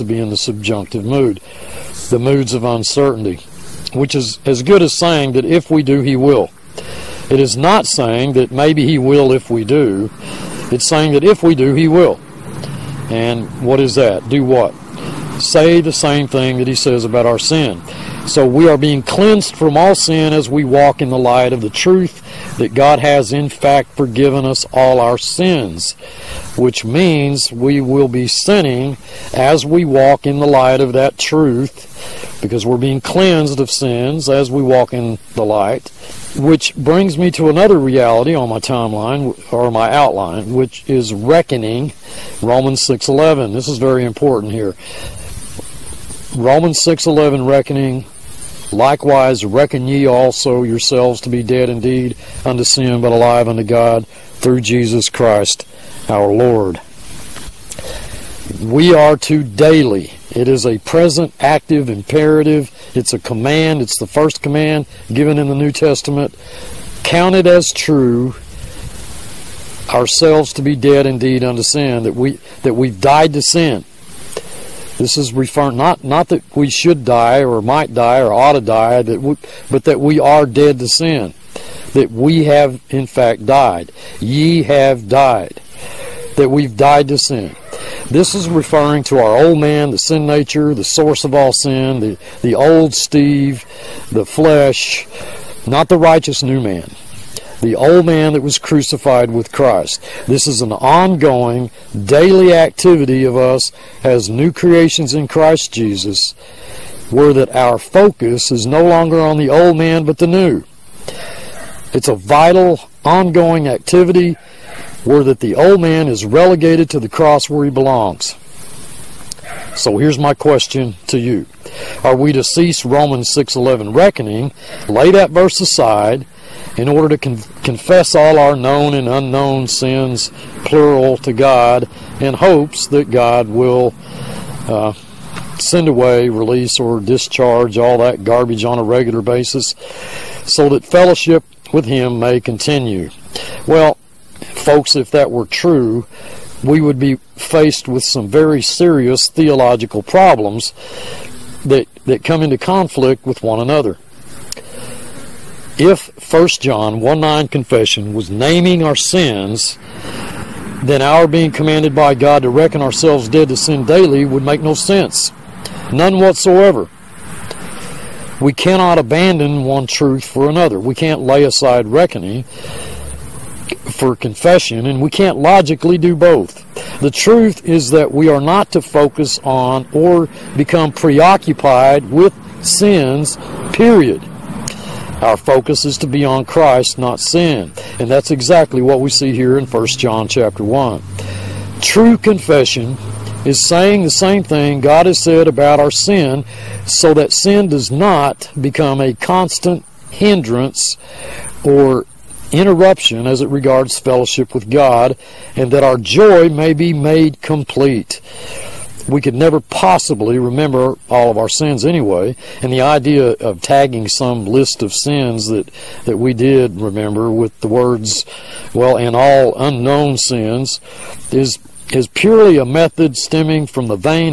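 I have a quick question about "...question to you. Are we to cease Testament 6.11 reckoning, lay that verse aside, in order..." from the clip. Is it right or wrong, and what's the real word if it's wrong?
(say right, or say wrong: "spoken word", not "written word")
wrong: "Romans", not "Testament".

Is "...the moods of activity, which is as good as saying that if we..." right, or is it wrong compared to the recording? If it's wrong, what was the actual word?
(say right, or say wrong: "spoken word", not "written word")
wrong: "uncertainty", not "activity".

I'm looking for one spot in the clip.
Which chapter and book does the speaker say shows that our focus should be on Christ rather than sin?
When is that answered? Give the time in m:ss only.
3:09.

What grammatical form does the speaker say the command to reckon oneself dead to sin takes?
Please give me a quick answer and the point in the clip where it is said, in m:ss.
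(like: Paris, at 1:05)
present, active imperative, at 1:00.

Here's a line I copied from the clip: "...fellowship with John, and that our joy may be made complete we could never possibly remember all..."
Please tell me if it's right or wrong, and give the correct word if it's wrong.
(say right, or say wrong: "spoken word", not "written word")
wrong: "God", not "John".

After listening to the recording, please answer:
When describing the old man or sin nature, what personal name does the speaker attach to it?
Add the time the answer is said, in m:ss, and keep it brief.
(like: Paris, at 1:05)
Steve, at 1:32.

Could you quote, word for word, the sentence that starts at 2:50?
We can't lay aside reckoning for confession, and we can't logically do both.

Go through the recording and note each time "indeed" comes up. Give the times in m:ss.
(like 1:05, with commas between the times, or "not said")
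0:51, 1:11.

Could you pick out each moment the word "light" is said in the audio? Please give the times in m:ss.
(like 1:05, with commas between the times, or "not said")
0:21, 0:30, 0:35.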